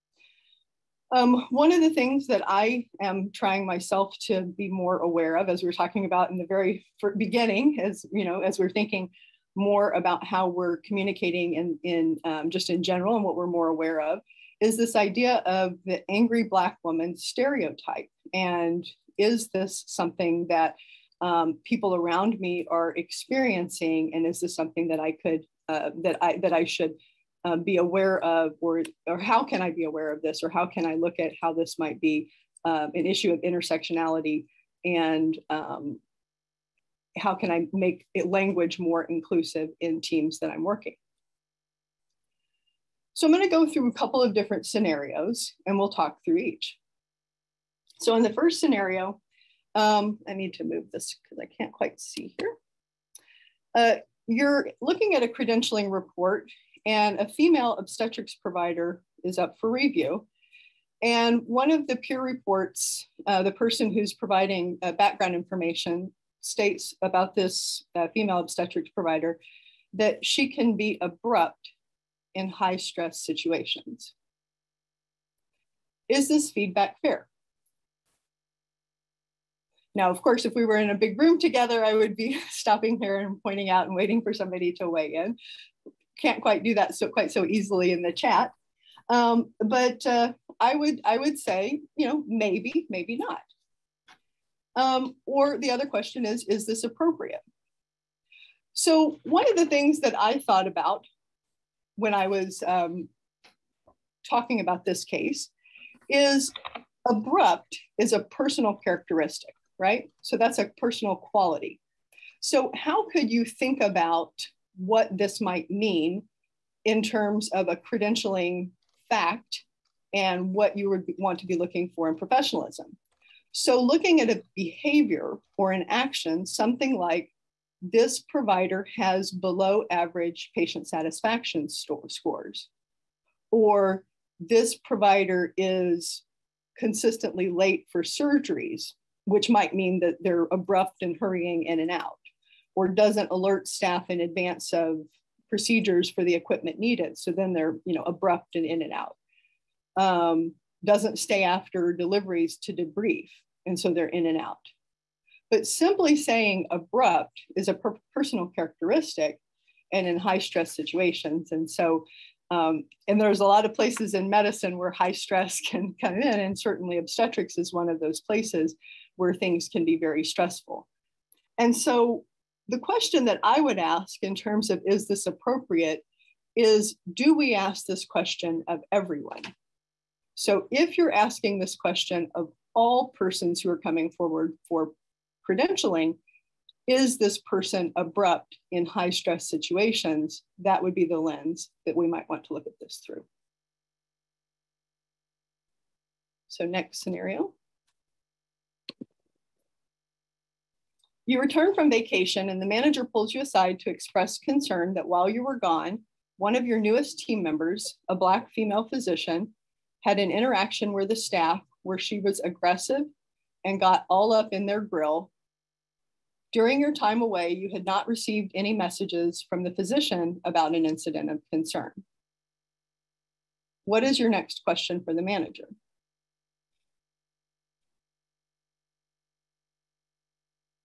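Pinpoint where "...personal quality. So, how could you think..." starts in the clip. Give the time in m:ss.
1:50.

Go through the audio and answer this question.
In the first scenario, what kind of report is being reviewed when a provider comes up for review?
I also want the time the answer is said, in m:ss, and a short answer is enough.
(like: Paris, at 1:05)
Credentialing report, at 0:55.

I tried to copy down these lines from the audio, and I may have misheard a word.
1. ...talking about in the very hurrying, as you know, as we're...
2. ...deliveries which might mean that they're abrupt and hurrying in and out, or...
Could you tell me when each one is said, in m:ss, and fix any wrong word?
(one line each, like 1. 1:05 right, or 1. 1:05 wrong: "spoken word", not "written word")
1. 0:05 wrong: "beginning", not "hurrying"
2. 2:18 wrong: "surgeries", not "deliveries".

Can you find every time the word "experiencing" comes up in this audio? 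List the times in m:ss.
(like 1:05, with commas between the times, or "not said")
0:22.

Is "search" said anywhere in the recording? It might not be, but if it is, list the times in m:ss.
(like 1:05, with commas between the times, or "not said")
not said.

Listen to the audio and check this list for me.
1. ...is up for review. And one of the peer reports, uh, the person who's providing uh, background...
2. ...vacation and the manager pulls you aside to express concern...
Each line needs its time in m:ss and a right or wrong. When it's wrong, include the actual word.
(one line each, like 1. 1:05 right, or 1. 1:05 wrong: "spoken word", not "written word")
1. 0:59 right
2. 3:21 right.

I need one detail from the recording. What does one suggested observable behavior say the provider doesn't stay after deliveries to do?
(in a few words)
Debrief.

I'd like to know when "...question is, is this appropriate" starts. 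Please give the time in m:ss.
1:35.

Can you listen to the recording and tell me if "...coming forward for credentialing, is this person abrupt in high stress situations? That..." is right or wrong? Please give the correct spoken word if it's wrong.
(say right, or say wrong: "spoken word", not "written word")
right.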